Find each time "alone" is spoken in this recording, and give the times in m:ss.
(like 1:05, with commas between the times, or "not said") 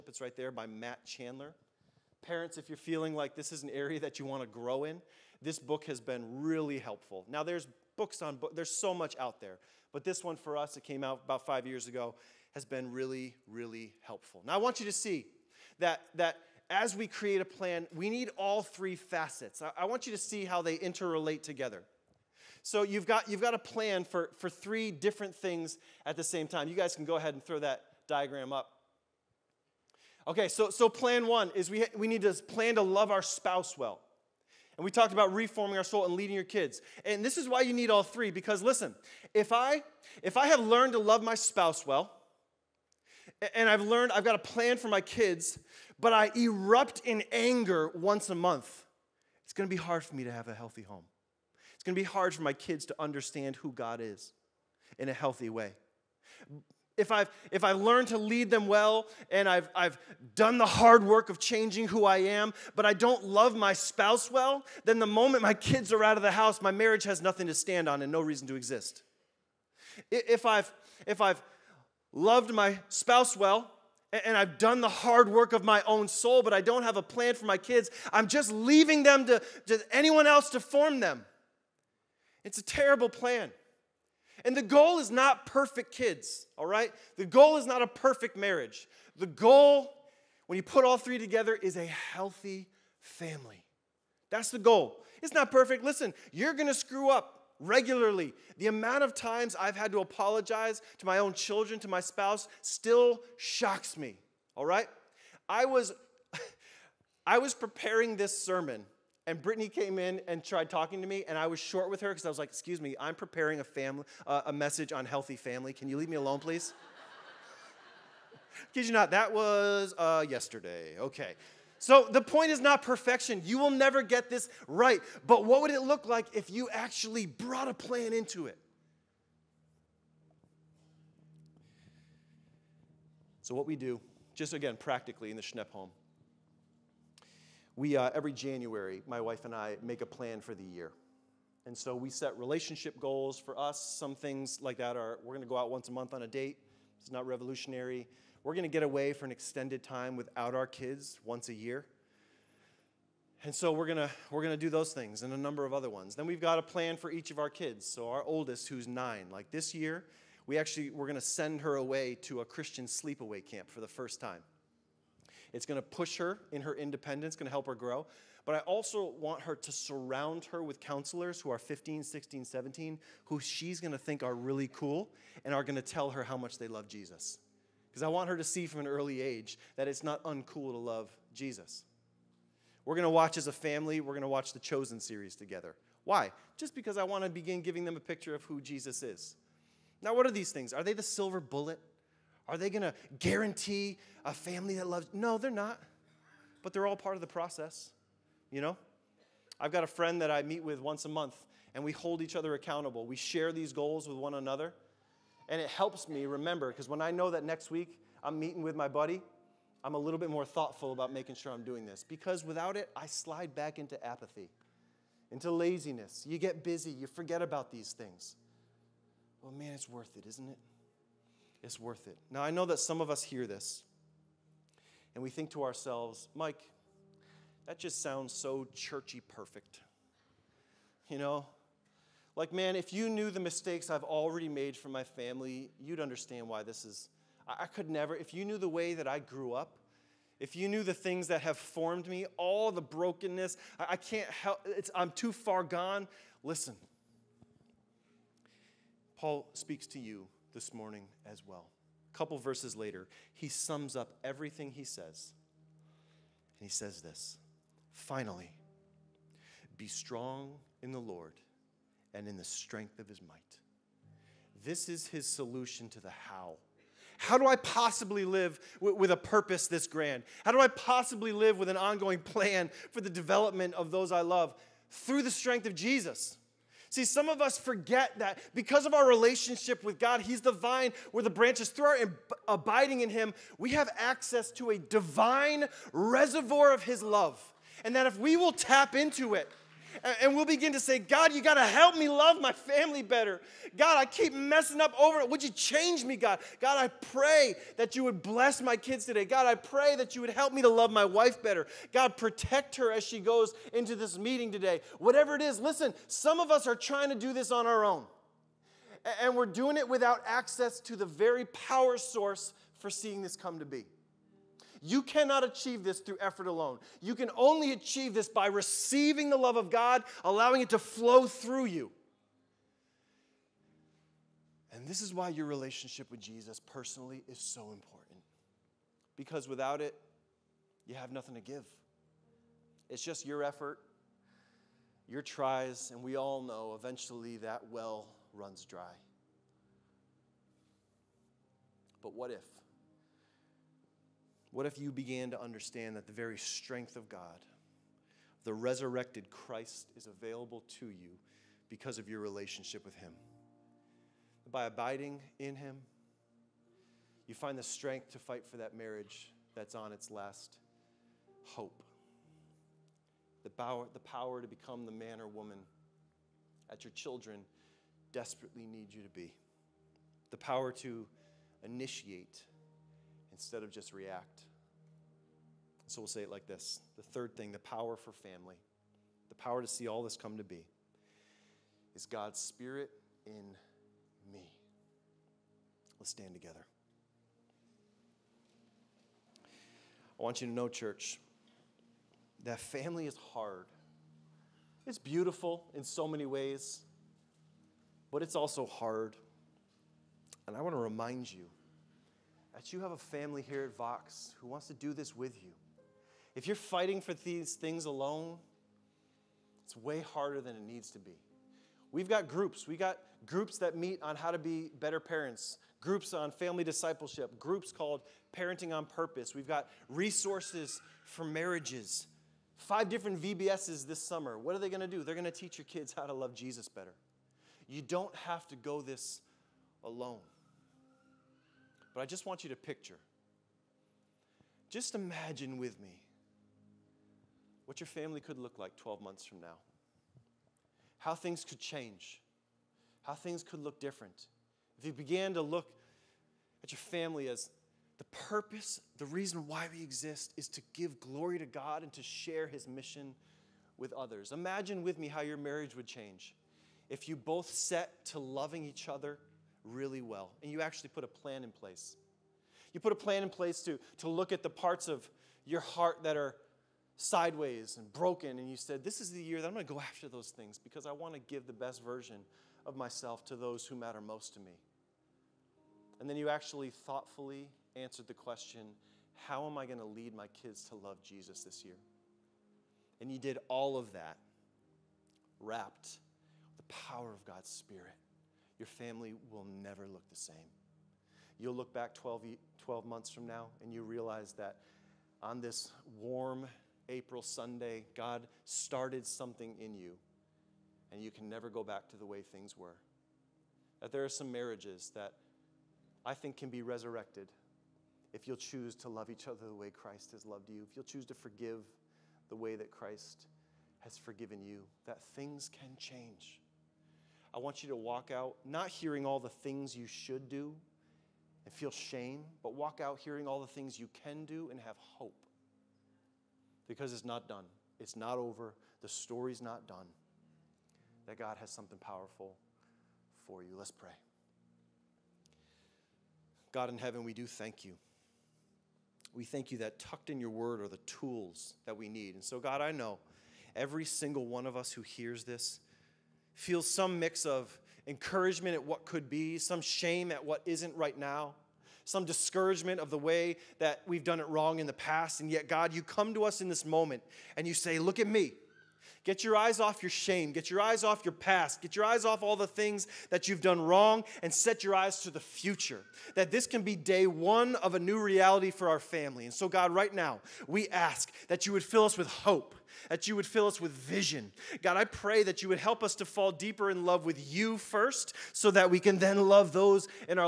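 1:56, 5:16, 6:47, 7:09.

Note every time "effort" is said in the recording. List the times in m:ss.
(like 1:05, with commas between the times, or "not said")
5:16, 5:33.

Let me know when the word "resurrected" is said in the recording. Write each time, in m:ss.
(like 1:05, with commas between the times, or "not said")
5:48, 8:26.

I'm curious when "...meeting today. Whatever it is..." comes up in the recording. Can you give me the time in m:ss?
5:04.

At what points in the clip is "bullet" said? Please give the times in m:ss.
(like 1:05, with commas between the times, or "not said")
3:11.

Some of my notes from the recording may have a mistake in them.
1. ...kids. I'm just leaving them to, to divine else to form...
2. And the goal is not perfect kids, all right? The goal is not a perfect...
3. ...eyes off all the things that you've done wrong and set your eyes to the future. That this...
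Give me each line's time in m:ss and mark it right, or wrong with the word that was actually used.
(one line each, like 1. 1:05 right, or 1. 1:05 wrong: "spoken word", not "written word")
1. 1:17 wrong: "anyone", not "divine"
2. 1:24 right
3. 9:21 right.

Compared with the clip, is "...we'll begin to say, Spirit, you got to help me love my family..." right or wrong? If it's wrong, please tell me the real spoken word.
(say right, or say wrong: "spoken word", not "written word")
wrong: "God", not "Spirit".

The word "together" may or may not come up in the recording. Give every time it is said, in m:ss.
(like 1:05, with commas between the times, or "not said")
0:21, 1:31, 3:05, 6:26.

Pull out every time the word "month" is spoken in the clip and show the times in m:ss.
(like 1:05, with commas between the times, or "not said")
0:48, 2:25, 3:21, 7:19, 8:12.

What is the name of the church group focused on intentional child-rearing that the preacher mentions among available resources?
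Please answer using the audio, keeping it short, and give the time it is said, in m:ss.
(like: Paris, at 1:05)
Parenting on Purpose, at 6:58.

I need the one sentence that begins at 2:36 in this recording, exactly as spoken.
Then we've got a plan for each of our kids.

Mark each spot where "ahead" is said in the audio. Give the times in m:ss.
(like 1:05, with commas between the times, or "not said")
0:27.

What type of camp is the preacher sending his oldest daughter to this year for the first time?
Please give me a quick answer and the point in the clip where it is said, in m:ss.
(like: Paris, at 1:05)
Christian sleepaway camp, at 2:42.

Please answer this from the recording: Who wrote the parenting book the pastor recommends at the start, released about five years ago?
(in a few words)
Matt Chandler.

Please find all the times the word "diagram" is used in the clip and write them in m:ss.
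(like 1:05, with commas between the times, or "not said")
0:28.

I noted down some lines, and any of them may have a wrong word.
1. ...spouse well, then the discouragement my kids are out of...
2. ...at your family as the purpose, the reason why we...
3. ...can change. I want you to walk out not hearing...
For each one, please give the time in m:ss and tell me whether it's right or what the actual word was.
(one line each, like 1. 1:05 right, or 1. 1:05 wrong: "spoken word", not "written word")
1. 1:03 wrong: "moment", not "discouragement"
2. 7:26 right
3. 8:35 right.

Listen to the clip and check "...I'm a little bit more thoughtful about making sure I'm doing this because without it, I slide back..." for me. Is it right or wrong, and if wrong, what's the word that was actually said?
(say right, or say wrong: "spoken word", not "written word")
right.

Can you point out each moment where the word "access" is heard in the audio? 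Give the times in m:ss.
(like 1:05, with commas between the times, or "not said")
4:43, 5:10.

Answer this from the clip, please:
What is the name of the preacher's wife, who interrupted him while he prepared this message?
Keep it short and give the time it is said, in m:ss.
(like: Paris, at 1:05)
Brittany, at 1:49.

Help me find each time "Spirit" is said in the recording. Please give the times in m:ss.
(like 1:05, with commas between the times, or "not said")
6:22, 8:07.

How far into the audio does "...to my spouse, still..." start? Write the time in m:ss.
1:41.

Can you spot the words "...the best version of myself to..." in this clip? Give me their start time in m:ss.
7:51.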